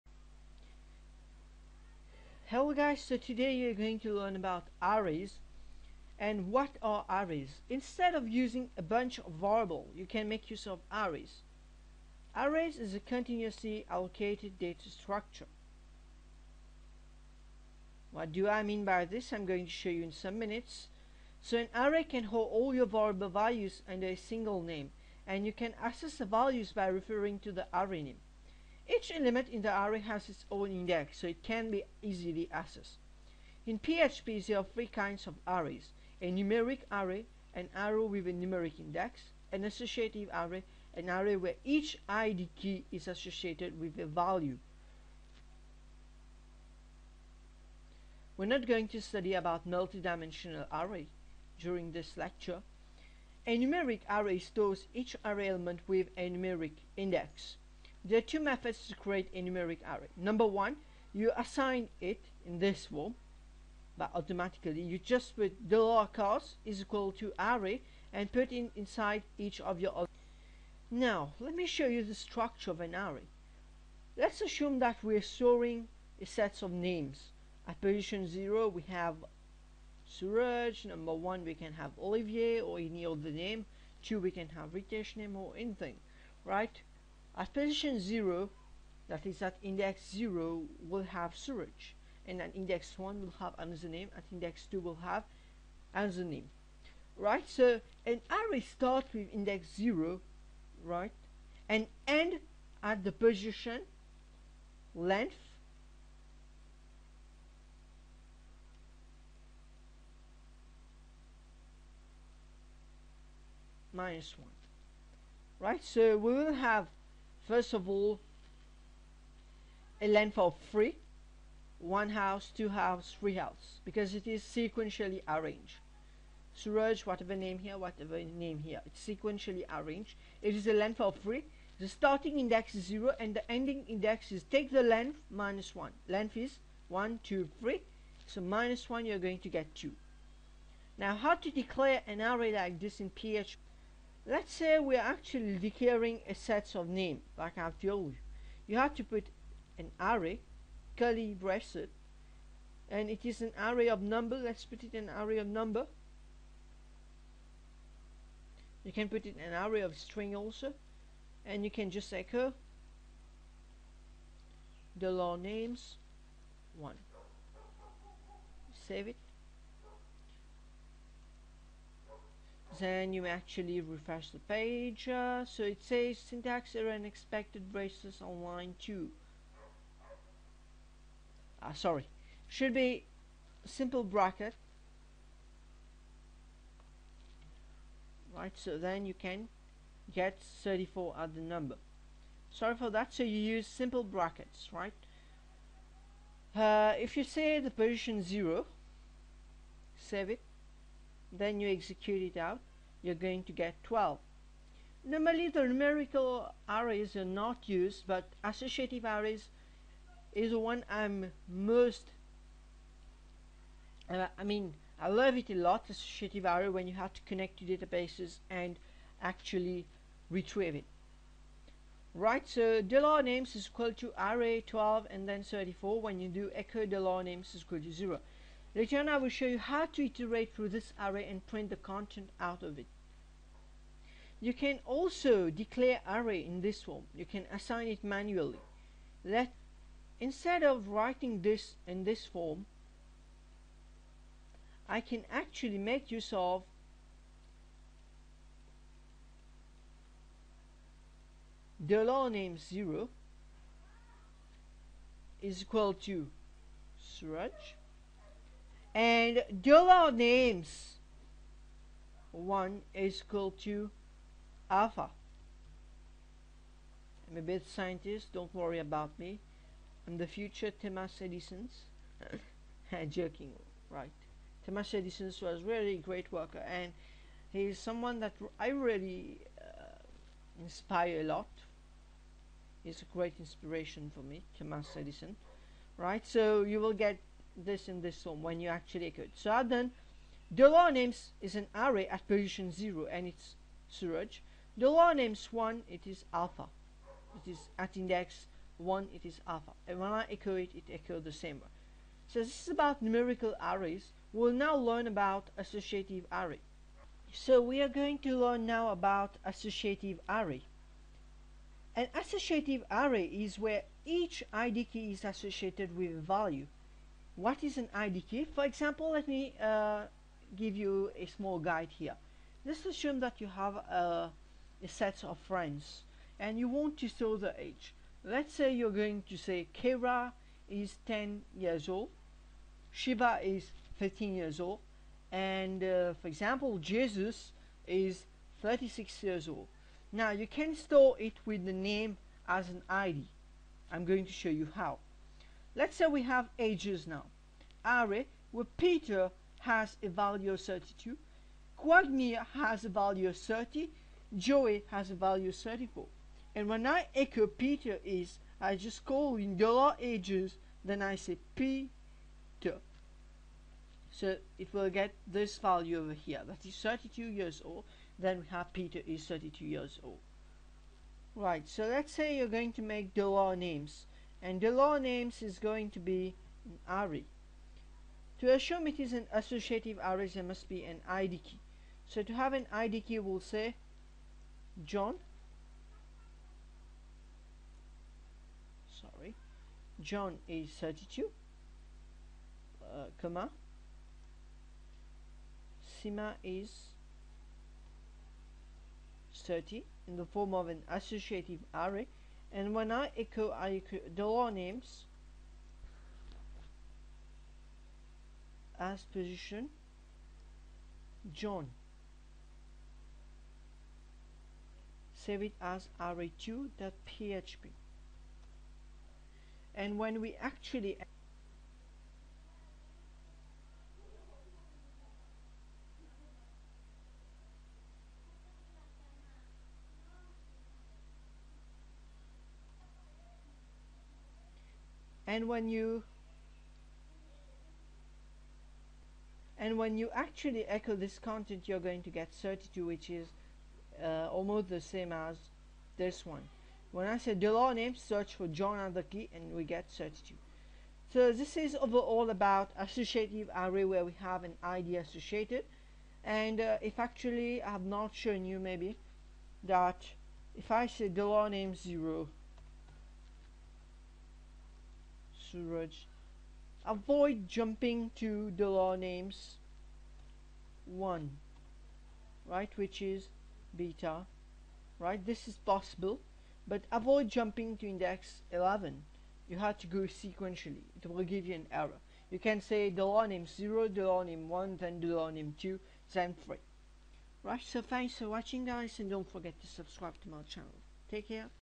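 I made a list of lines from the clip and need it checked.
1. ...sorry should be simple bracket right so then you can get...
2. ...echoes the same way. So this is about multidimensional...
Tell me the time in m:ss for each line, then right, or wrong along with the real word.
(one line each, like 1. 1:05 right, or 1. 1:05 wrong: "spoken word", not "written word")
1. 3:01 right
2. 5:00 wrong: "numerical", not "multidimensional".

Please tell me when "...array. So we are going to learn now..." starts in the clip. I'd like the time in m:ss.
5:06.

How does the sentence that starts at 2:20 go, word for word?
Now how to declare an array like this in PHP?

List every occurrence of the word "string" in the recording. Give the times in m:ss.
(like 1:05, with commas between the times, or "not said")
2:39.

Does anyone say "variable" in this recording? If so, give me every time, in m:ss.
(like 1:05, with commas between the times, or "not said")
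0:09, 0:22.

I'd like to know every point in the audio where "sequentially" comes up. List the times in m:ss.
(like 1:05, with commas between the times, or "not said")
2:04, 2:09, 8:00.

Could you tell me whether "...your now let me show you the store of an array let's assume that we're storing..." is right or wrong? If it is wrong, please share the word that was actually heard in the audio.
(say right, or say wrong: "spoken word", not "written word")
wrong: "structure", not "store".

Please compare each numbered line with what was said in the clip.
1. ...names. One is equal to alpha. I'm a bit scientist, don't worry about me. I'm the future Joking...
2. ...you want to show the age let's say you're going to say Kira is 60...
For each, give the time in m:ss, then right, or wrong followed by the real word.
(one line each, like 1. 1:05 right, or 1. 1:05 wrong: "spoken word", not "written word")
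1. 4:20 wrong: "Thomas", not "Joking"
2. 5:26 wrong: "10", not "60".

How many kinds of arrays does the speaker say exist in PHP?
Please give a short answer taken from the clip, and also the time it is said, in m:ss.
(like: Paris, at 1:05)
3, at 0:34.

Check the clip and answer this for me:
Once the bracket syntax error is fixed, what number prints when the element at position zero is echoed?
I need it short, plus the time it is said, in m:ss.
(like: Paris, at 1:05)
12, at 3:23.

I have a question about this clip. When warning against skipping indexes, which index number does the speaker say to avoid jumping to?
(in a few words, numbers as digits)
11.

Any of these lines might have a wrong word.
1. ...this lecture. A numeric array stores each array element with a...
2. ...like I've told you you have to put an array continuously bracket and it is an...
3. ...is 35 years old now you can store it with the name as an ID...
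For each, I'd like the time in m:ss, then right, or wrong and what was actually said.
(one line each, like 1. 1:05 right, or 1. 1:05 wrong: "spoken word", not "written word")
1. 0:51 right
2. 2:27 wrong: "curly", not "continuously"
3. 5:37 wrong: "36", not "35".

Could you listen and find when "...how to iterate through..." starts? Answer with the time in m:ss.
3:49.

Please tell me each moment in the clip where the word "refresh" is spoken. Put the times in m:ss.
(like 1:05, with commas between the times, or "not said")
2:53.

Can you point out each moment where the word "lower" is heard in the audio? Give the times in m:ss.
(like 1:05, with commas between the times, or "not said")
1:05.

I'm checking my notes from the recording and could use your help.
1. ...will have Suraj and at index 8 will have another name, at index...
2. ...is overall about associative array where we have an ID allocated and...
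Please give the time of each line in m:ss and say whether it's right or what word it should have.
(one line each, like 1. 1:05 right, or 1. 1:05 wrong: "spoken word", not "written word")
1. 1:30 wrong: "1", not "8"
2. 7:31 wrong: "associated", not "allocated".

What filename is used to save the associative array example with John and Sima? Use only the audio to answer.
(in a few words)
array2.php.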